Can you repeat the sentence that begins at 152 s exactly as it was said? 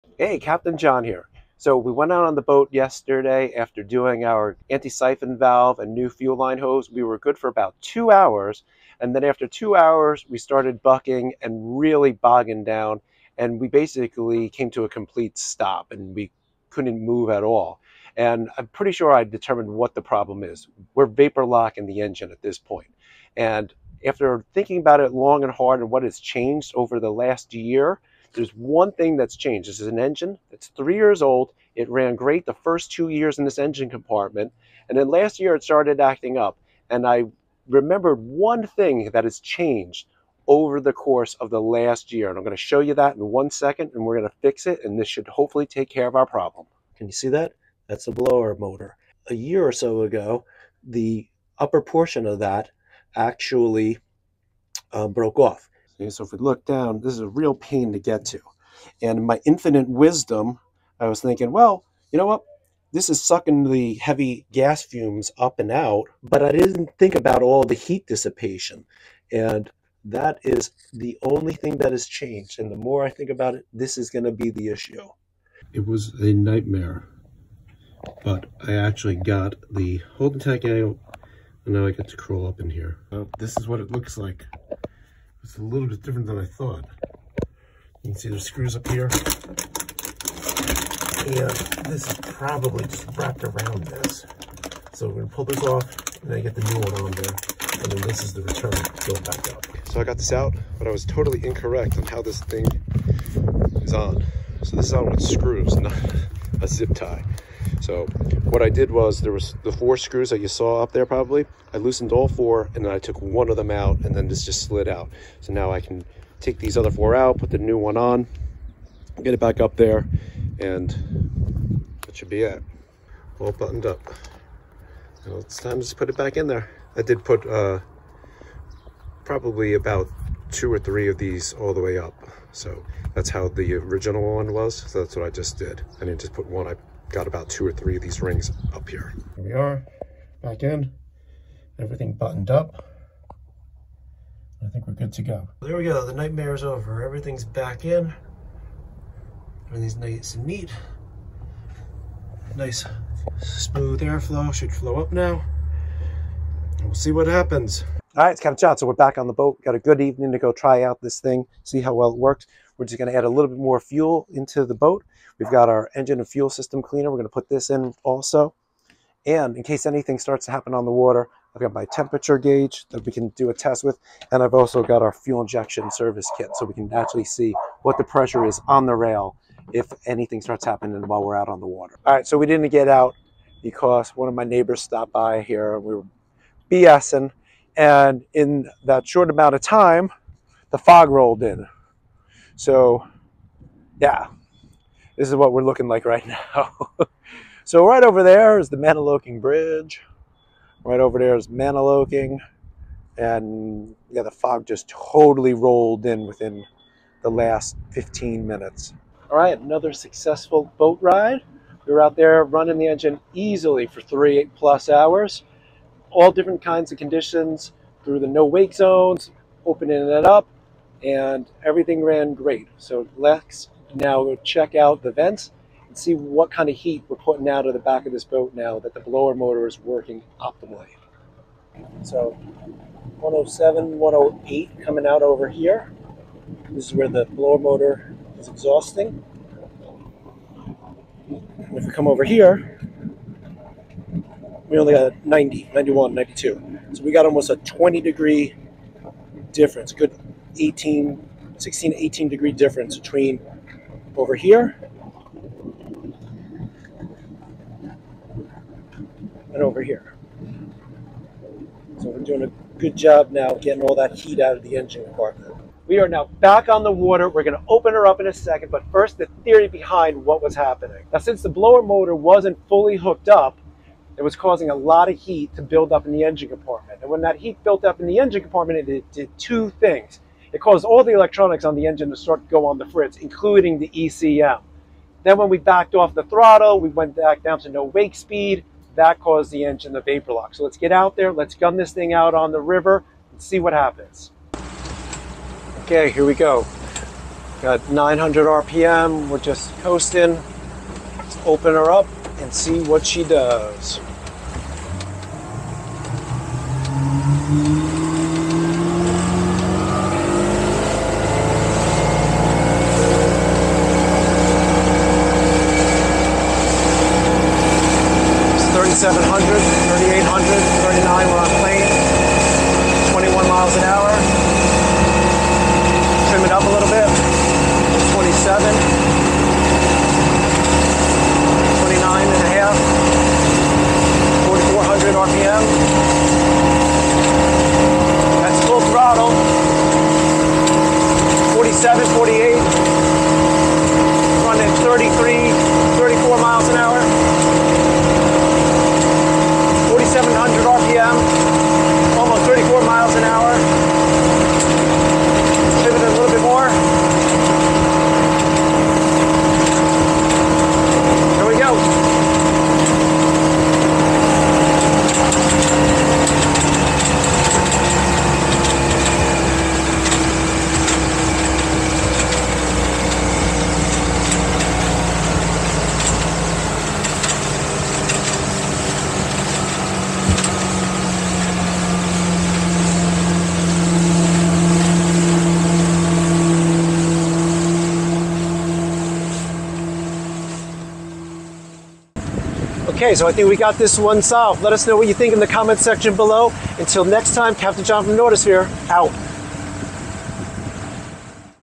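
Nice smooth airflow, should flow up now.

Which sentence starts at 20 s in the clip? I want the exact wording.
We're vapor locking the engine at this point.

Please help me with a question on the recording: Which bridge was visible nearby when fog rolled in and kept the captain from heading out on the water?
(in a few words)
Mantoloking Bridge.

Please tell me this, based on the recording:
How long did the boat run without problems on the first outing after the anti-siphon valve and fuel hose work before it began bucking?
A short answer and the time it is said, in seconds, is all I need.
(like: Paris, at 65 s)
about two hours, at 7 s.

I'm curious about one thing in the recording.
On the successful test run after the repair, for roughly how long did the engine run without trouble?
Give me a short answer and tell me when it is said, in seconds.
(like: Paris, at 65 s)
three plus hours, at 214 s.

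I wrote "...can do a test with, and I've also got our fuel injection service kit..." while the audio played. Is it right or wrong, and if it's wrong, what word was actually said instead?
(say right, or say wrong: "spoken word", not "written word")
right.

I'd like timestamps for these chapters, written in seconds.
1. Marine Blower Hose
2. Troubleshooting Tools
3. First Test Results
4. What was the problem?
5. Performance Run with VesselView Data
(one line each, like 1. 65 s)
1. 45 s
2. 160 s
3. 208 s
4. 265 s
5. 295 s.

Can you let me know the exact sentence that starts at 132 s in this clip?
So that's how the original one was.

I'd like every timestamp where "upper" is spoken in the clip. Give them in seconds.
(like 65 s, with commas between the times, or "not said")
51 s.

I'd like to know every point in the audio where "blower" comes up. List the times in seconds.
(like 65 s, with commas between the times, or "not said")
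48 s, 228 s, 237 s, 271 s.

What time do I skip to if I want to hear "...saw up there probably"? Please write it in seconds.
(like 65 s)
110 s.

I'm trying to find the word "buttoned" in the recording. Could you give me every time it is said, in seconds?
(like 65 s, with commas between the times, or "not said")
123 s, 142 s.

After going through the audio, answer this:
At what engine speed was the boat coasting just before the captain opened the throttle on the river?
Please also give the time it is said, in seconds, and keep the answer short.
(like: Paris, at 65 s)
900 RPM, at 297 s.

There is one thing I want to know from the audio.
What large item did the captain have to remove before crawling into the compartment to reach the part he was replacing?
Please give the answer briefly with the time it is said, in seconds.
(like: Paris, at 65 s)
holding tank, at 80 s.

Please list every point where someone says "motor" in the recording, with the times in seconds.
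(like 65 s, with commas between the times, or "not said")
48 s, 229 s, 237 s, 271 s.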